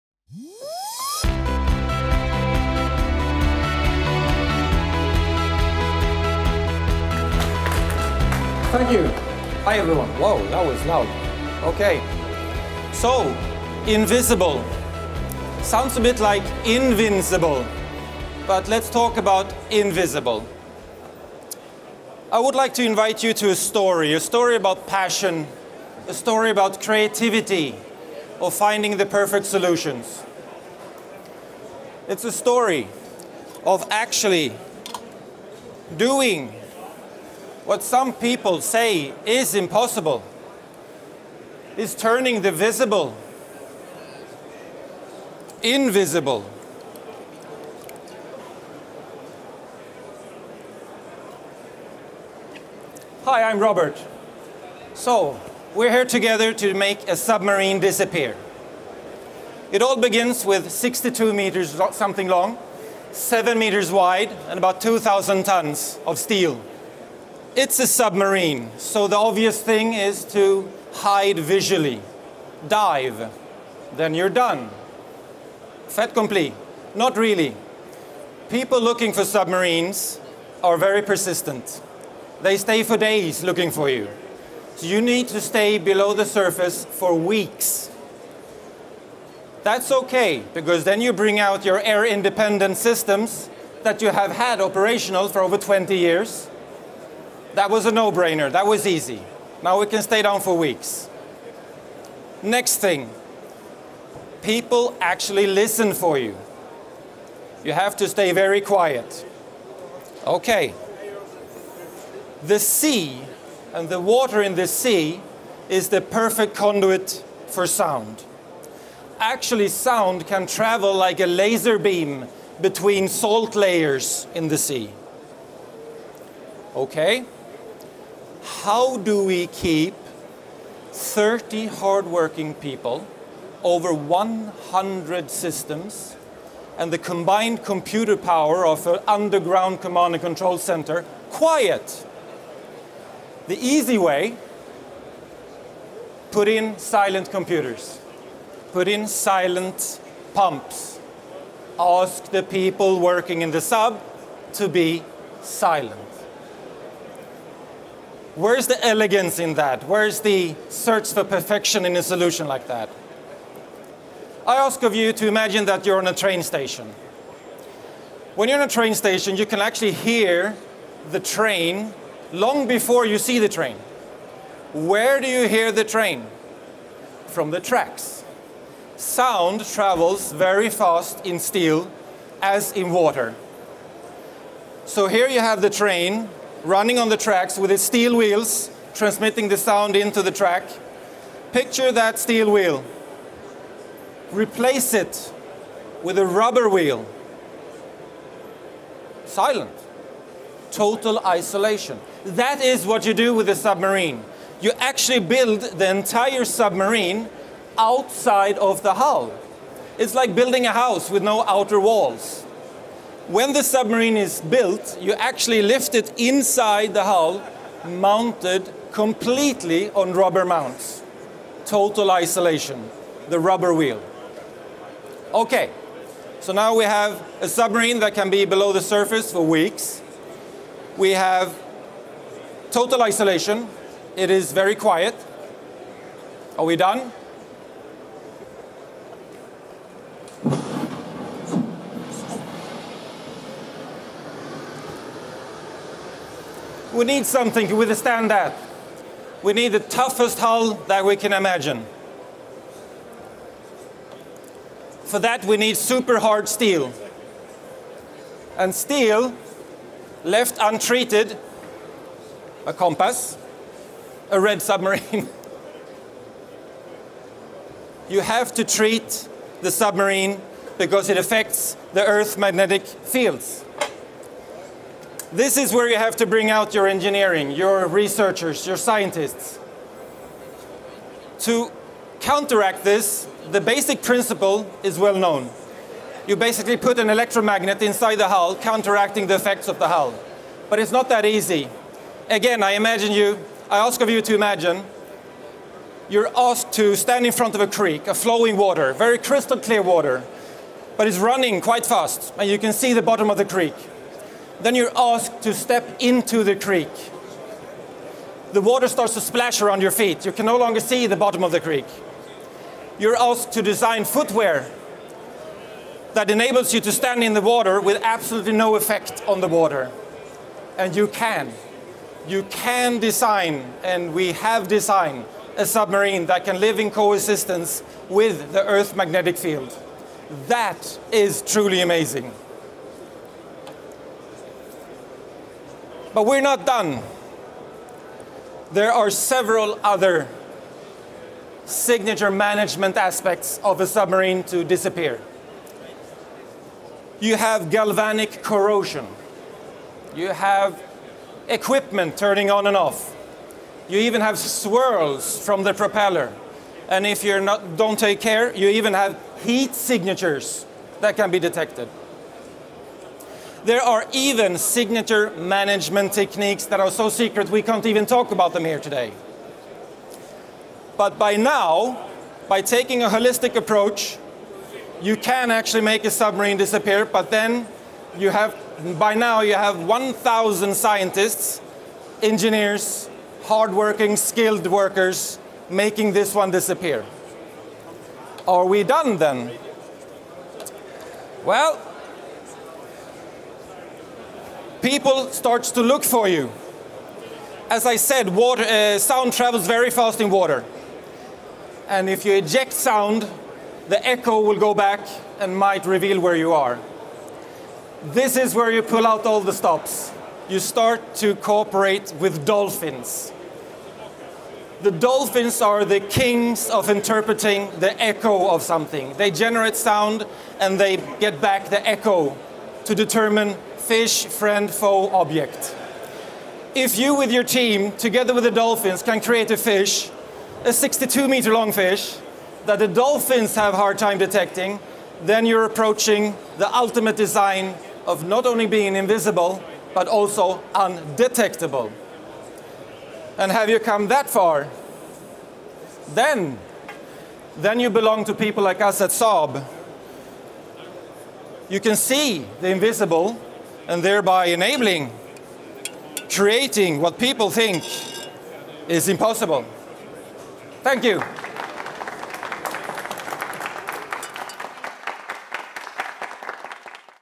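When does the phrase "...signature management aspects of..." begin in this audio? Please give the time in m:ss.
5:41.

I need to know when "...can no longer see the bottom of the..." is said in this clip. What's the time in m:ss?
5:10.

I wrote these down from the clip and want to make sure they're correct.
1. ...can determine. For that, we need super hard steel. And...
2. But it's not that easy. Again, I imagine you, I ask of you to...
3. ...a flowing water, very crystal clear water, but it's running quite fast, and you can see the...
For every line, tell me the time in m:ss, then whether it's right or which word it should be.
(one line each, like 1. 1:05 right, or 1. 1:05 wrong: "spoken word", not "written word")
1. 4:11 wrong: "imagine", not "determine"
2. 4:50 right
3. 4:58 right.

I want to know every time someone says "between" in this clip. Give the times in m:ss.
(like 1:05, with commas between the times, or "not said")
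2:02.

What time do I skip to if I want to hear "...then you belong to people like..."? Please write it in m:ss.
7:27.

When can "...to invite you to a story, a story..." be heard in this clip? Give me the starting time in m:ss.
0:22.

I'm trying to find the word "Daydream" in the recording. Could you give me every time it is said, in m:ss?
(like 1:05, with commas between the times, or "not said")
not said.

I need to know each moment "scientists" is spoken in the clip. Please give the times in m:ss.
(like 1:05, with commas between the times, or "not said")
4:38, 6:20.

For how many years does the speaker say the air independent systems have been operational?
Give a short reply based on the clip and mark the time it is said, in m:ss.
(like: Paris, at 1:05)
over 20 years, at 1:35.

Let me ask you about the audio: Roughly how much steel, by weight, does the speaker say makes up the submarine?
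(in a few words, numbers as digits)
2,000 tons.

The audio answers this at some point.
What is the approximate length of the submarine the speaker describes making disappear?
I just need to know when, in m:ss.
1:00.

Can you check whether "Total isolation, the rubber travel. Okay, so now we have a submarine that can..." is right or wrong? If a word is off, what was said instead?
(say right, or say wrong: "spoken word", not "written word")
wrong: "wheel", not "travel".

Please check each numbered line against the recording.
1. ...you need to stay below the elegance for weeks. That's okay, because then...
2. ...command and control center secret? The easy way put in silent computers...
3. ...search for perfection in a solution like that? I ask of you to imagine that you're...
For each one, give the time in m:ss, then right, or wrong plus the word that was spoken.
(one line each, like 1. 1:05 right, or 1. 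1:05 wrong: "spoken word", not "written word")
1. 1:24 wrong: "surface", not "elegance"
2. 2:19 wrong: "quiet", not "secret"
3. 2:40 right.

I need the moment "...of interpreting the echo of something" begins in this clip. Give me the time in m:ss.
6:56.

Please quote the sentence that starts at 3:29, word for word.
It's like building a house with no outer walls.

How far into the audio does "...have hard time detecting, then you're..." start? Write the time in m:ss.
7:13.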